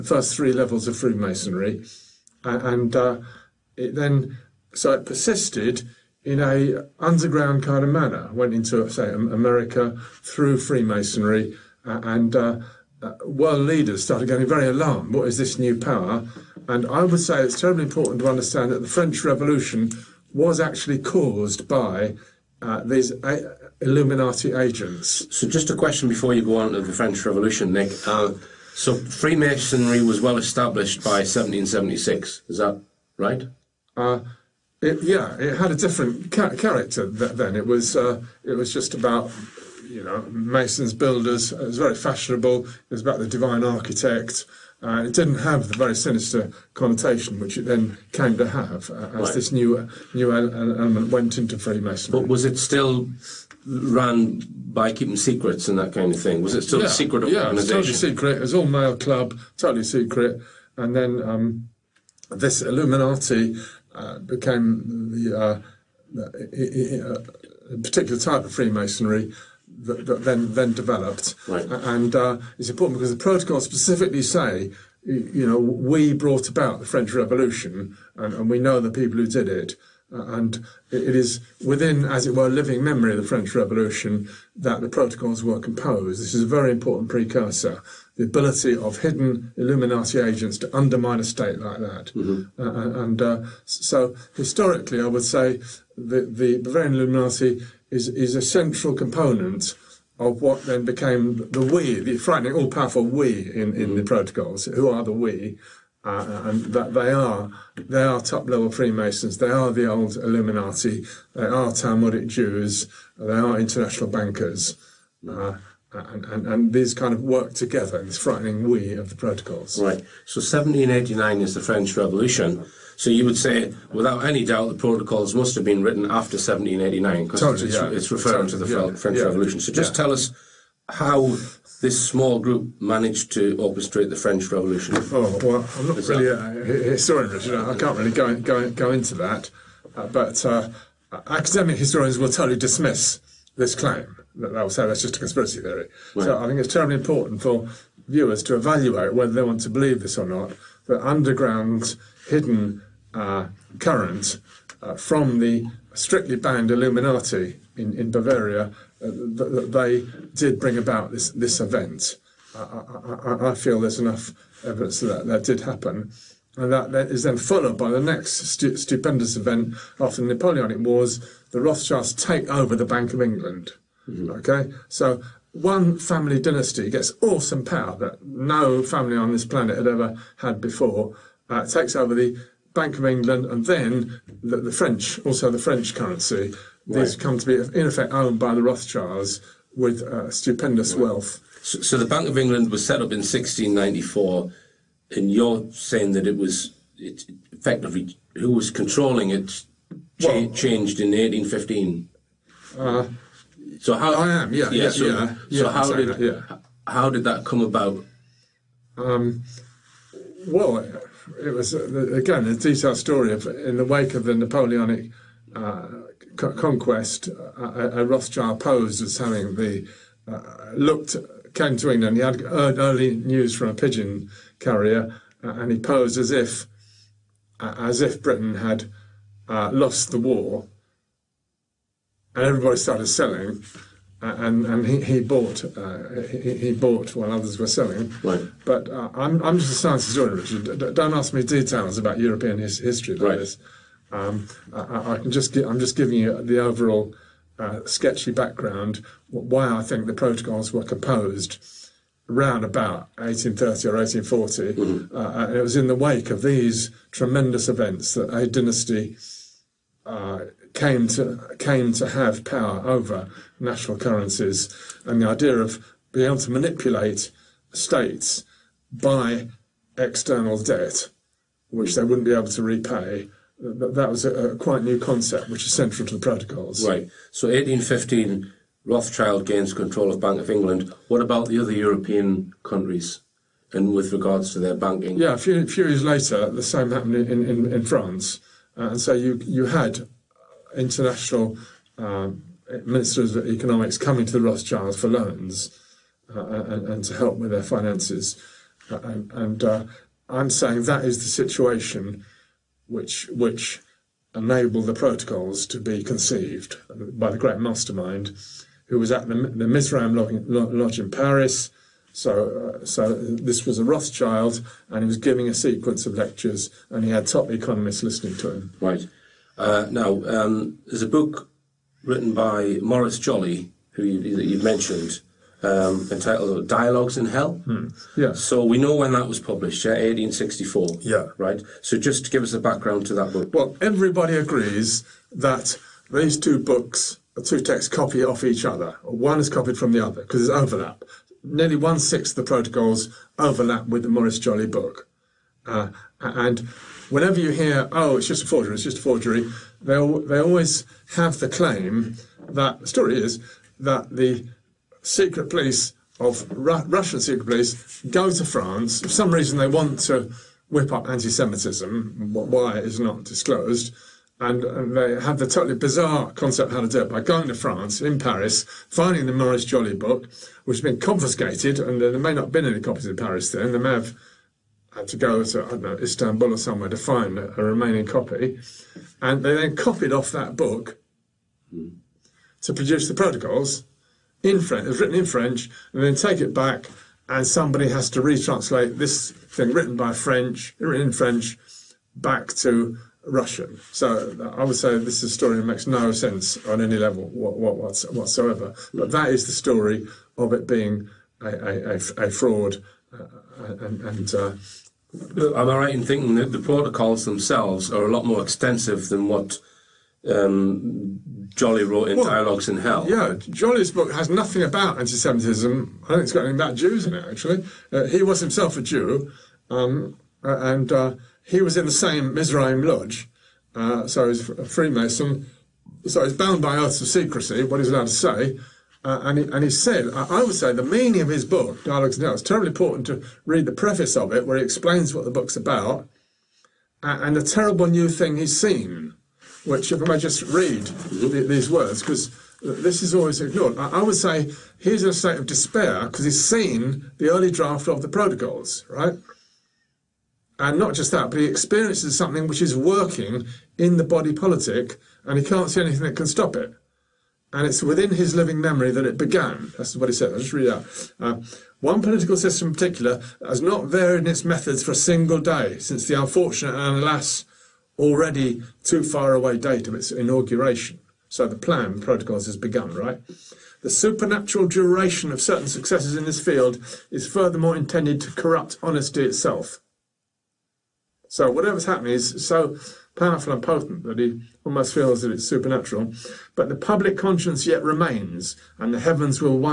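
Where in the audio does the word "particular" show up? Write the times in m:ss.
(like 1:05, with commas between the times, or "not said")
1:07, 7:42.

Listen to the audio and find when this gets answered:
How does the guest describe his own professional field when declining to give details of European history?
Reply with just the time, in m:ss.
3:59.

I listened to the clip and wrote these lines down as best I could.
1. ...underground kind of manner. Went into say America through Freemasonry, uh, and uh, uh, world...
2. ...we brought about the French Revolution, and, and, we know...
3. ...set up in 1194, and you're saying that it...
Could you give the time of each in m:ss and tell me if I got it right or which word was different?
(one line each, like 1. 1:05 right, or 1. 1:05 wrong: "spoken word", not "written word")
1. 0:06 right
2. 1:15 right
3. 3:12 wrong: "1694", not "1194".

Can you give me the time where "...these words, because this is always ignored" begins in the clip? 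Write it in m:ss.
7:21.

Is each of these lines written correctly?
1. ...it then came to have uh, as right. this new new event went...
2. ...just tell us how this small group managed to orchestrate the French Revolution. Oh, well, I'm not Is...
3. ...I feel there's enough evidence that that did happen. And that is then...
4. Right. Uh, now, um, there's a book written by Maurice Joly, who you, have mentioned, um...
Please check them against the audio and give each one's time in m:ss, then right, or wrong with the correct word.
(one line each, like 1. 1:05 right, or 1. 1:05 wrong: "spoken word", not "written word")
1. 0:47 wrong: "element", not "event"
2. 2:09 right
3. 2:43 right
4. 5:18 right.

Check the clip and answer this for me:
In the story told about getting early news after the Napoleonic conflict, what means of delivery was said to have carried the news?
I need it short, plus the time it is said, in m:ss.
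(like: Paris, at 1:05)
pigeon carrier, at 3:43.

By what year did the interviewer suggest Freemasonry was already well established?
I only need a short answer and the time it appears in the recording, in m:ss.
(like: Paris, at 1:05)
1776, at 0:31.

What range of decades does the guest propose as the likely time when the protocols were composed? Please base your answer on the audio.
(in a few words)
1830 or 1840.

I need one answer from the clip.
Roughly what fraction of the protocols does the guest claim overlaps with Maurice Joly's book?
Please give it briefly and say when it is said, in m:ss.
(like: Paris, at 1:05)
one sixth, at 5:41.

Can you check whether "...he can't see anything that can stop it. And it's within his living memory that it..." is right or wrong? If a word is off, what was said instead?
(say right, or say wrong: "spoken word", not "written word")
right.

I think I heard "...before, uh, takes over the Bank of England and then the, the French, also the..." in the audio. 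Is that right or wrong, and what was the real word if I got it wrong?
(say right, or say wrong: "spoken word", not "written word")
right.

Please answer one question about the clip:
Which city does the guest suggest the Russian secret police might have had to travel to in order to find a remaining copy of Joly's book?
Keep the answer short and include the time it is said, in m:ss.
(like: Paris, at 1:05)
Istanbul, at 6:15.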